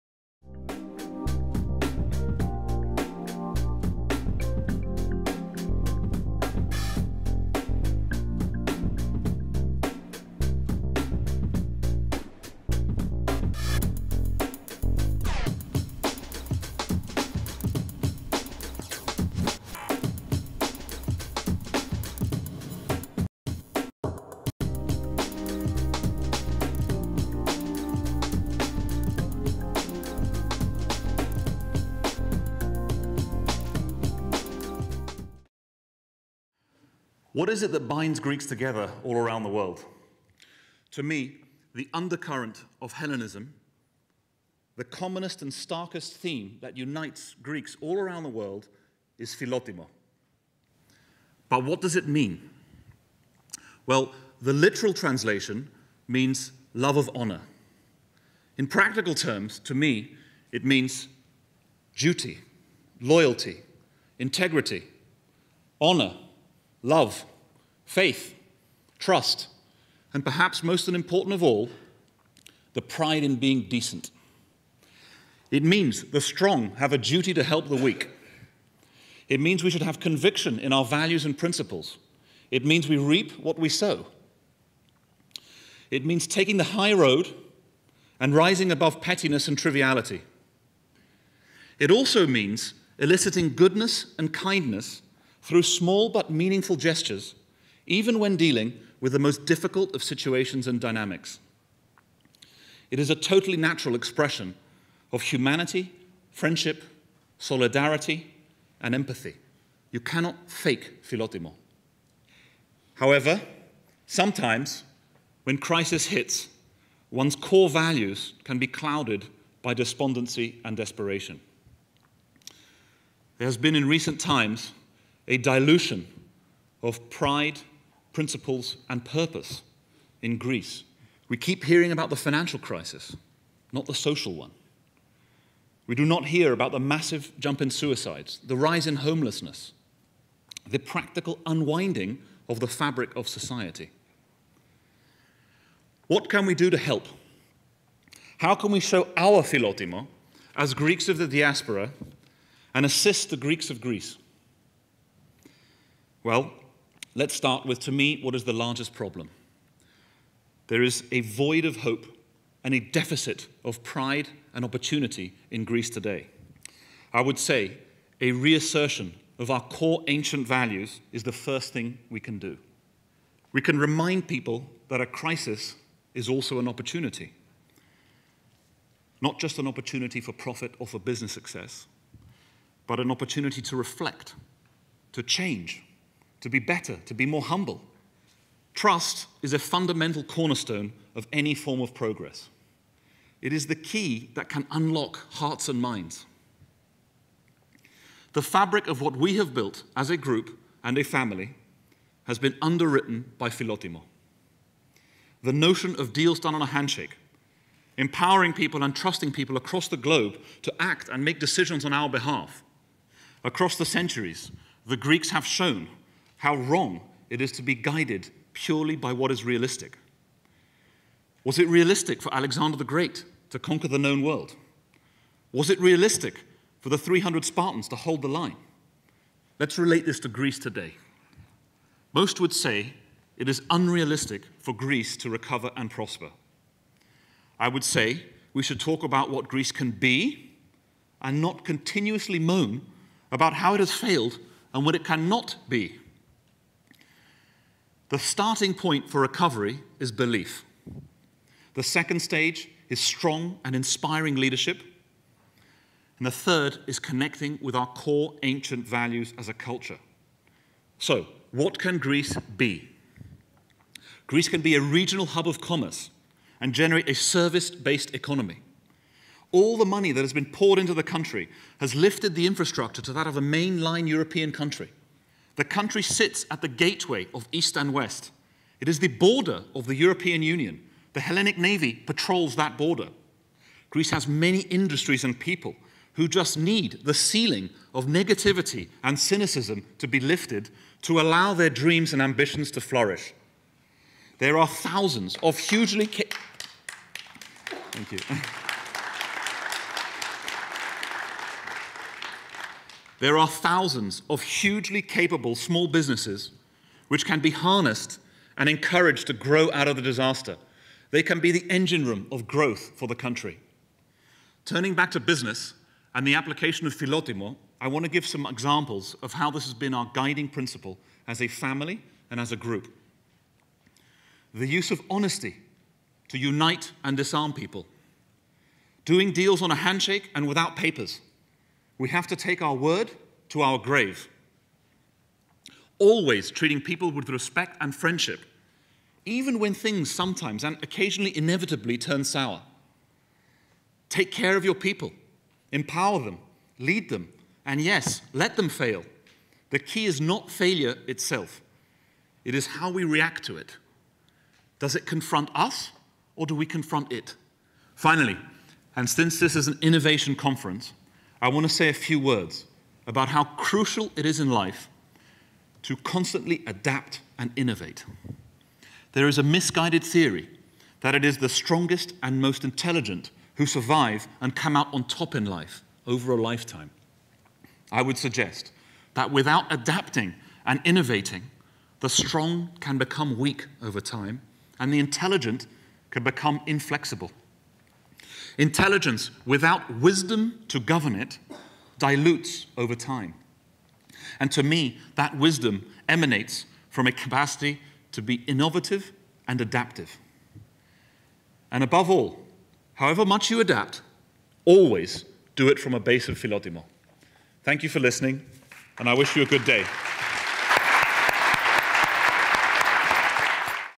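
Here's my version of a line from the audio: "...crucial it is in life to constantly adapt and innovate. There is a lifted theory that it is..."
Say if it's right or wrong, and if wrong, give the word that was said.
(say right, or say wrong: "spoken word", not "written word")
wrong: "misguided", not "lifted".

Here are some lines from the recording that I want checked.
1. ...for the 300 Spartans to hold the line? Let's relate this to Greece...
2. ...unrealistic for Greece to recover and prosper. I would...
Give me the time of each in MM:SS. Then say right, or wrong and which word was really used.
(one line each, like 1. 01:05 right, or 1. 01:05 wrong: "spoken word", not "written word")
1. 03:46 right
2. 03:53 right.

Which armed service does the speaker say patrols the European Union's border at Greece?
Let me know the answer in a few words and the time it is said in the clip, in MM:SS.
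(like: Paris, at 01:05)
Hellenic Navy, at 04:41.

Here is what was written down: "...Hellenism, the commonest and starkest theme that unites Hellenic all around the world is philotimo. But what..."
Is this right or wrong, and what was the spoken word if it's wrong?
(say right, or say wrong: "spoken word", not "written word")
wrong: "Greeks", not "Hellenic".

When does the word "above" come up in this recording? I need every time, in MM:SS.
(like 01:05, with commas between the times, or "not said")
01:28, 06:41.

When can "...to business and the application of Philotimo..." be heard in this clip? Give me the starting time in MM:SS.
05:15.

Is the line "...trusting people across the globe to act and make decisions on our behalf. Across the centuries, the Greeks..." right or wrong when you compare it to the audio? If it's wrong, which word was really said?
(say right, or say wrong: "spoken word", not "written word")
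right.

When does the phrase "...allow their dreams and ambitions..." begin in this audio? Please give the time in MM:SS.
04:51.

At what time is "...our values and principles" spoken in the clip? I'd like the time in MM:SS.
01:20.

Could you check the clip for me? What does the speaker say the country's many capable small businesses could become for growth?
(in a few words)
the engine room.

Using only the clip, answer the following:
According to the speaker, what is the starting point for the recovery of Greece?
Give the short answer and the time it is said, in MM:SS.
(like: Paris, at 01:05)
belief, at 04:10.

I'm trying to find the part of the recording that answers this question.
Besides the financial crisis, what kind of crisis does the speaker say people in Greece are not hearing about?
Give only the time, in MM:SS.
02:13.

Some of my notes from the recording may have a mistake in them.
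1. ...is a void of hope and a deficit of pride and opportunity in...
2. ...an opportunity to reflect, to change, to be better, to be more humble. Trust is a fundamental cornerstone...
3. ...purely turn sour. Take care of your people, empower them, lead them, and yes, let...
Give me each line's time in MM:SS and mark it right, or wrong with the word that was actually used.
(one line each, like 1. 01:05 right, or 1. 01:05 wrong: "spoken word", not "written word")
1. 02:40 right
2. 03:02 right
3. 05:41 wrong: "inevitably", not "purely".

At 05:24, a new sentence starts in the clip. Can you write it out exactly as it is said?
The use of honesty to unite and disarm people.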